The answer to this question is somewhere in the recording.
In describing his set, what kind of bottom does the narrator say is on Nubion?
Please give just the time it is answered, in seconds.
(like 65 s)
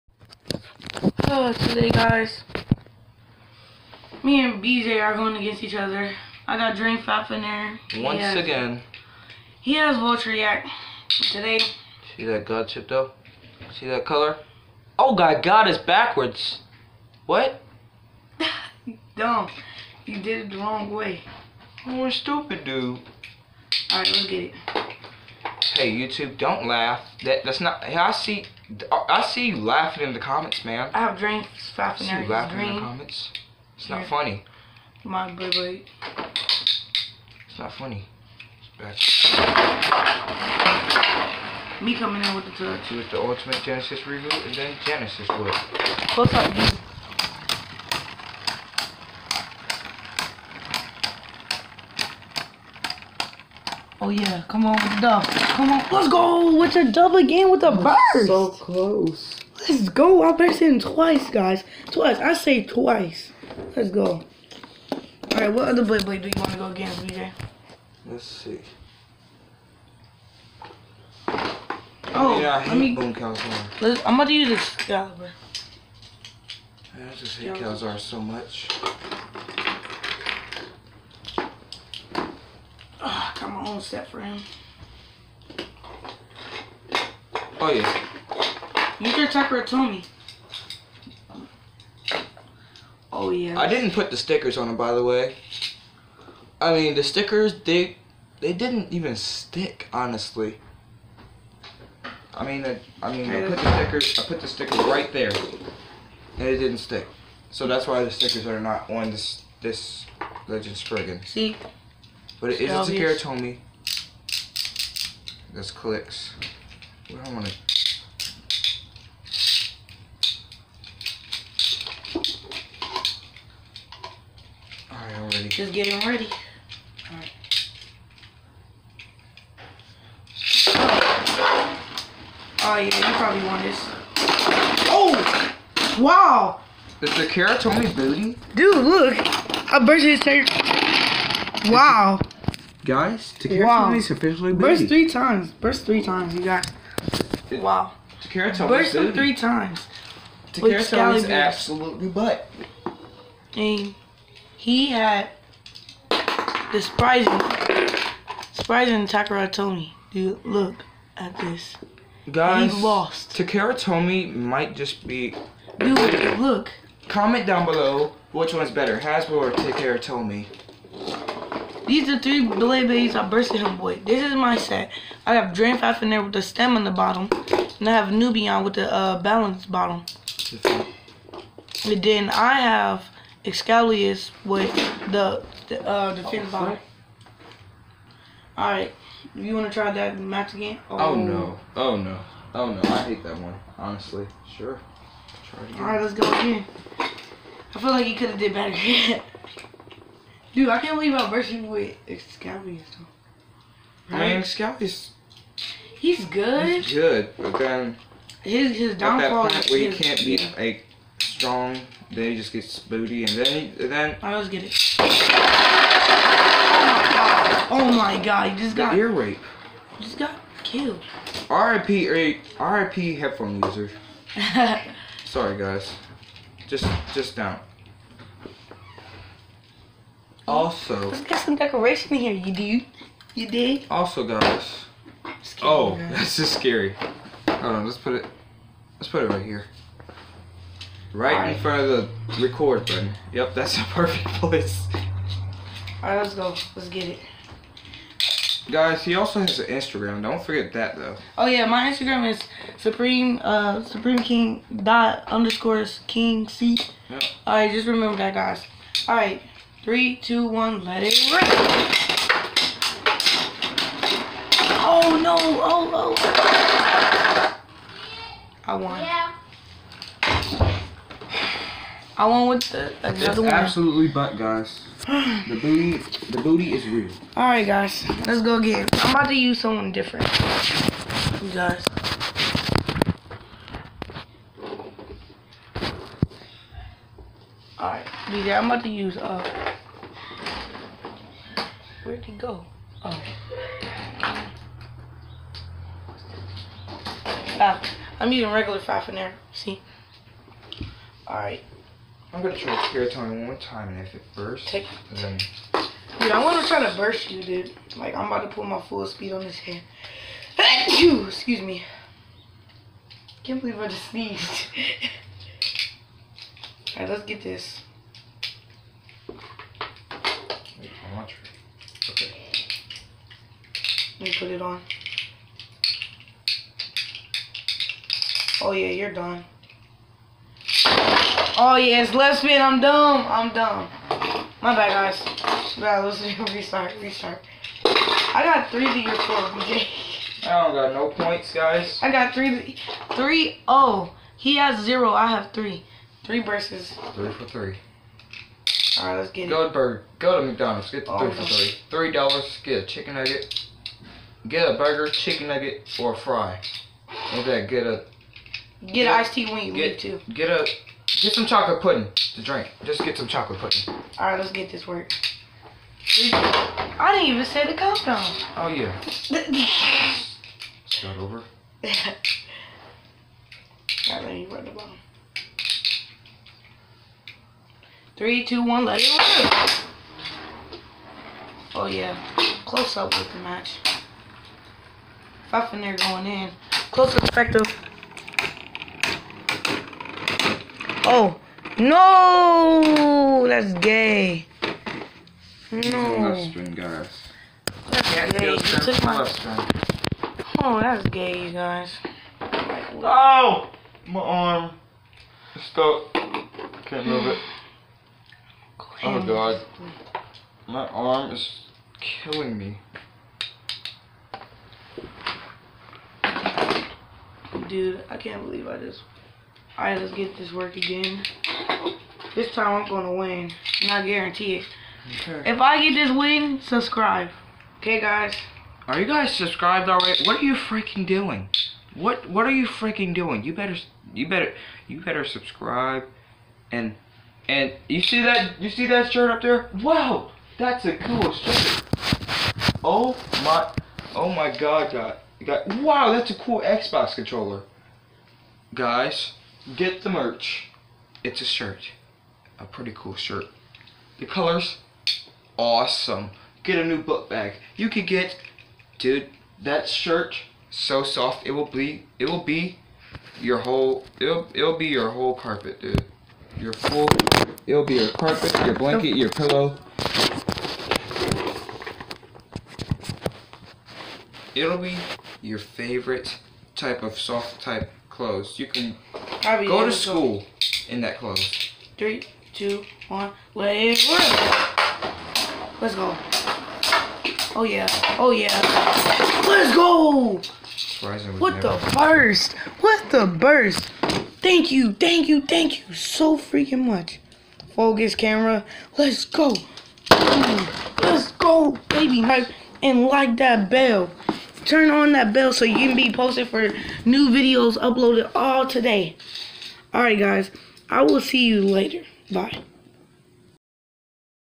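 179 s.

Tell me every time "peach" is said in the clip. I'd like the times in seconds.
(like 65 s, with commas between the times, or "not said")
not said.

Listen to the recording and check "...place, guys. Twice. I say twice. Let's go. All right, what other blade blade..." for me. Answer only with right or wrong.
wrong.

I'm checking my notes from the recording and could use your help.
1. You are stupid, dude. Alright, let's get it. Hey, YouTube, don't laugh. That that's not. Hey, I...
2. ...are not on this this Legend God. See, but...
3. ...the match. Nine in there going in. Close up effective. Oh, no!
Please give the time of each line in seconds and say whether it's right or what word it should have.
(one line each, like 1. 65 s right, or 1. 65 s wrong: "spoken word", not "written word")
1. 21 s right
2. 108 s wrong: "Spriggan", not "God"
3. 383 s wrong: "Five", not "Nine".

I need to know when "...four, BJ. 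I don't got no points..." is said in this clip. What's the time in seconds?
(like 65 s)
339 s.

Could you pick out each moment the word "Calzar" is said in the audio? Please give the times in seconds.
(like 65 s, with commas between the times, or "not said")
73 s, 77 s.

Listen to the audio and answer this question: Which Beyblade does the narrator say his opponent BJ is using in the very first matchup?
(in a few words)
Valtryek.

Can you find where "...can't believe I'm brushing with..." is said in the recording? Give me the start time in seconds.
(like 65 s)
200 s.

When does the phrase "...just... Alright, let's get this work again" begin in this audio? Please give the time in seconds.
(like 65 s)
418 s.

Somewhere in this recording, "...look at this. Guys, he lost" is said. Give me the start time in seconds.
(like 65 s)
160 s.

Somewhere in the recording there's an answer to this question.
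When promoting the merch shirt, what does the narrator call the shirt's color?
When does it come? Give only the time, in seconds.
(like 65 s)
455 s.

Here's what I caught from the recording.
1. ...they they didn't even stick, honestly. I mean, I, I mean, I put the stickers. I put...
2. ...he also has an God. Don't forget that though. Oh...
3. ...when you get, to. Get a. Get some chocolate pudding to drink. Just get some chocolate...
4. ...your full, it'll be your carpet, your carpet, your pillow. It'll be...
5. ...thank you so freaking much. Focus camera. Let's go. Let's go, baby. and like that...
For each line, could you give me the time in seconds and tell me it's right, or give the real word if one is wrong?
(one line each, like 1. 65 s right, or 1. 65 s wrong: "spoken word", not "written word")
1. 97 s right
2. 249 s wrong: "Instagram", not "God"
3. 359 s right
4. 466 s wrong: "blanket", not "carpet"
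5. 495 s right.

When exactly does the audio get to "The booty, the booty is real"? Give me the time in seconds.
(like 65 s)
275 s.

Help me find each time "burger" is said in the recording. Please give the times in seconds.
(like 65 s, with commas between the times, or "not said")
349 s, 354 s.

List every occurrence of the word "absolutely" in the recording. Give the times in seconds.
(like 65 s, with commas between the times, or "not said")
151 s, 273 s.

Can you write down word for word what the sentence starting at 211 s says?
strong, then he just gets booty, and then he, then.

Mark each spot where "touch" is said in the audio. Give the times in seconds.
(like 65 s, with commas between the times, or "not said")
42 s.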